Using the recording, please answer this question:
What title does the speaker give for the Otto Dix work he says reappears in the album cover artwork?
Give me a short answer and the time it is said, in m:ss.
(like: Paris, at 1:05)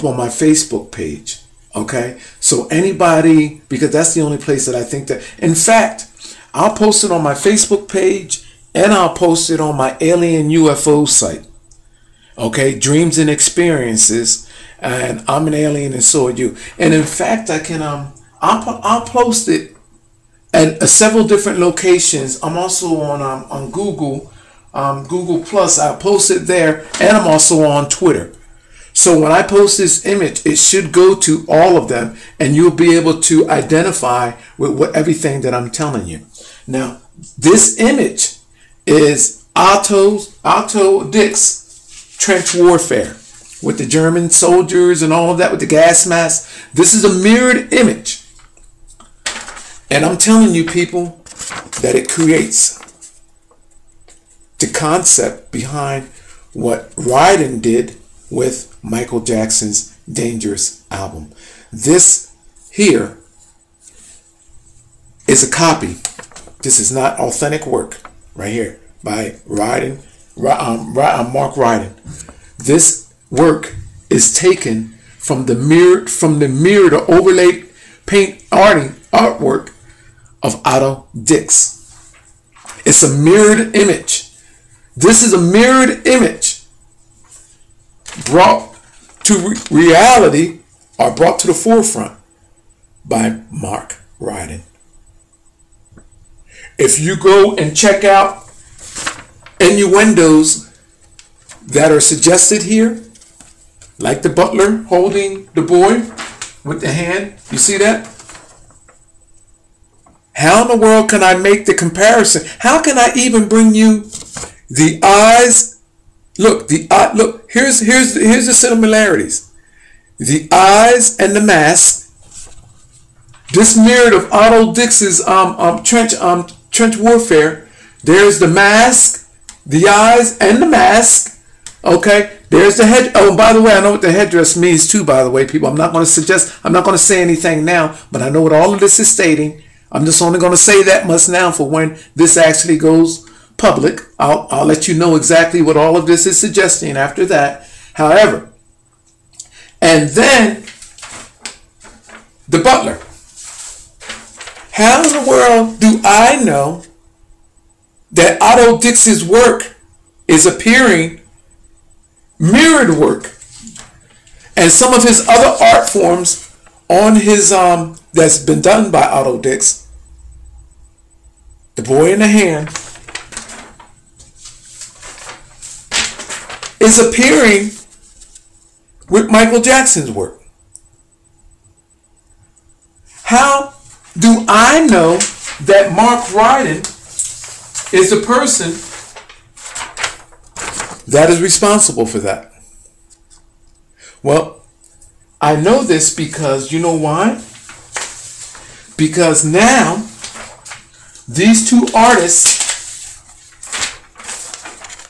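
The Boy in the Hand, at 2:51.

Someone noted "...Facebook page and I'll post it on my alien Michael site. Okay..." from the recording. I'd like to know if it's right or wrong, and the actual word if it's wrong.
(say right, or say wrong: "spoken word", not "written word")
wrong: "UFO", not "Michael".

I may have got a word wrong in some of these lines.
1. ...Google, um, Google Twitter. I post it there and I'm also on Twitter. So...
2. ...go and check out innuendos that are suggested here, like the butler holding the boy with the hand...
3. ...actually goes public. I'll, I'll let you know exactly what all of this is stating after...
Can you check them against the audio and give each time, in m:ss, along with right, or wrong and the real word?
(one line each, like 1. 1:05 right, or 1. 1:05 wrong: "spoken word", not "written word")
1. 0:23 wrong: "Plus", not "Twitter"
2. 1:37 right
3. 2:22 wrong: "suggesting", not "stating".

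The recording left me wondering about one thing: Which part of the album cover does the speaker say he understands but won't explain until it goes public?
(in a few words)
the headdress.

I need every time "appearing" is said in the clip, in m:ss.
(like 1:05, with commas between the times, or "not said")
2:40, 2:56.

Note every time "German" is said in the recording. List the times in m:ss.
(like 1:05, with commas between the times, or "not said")
0:43.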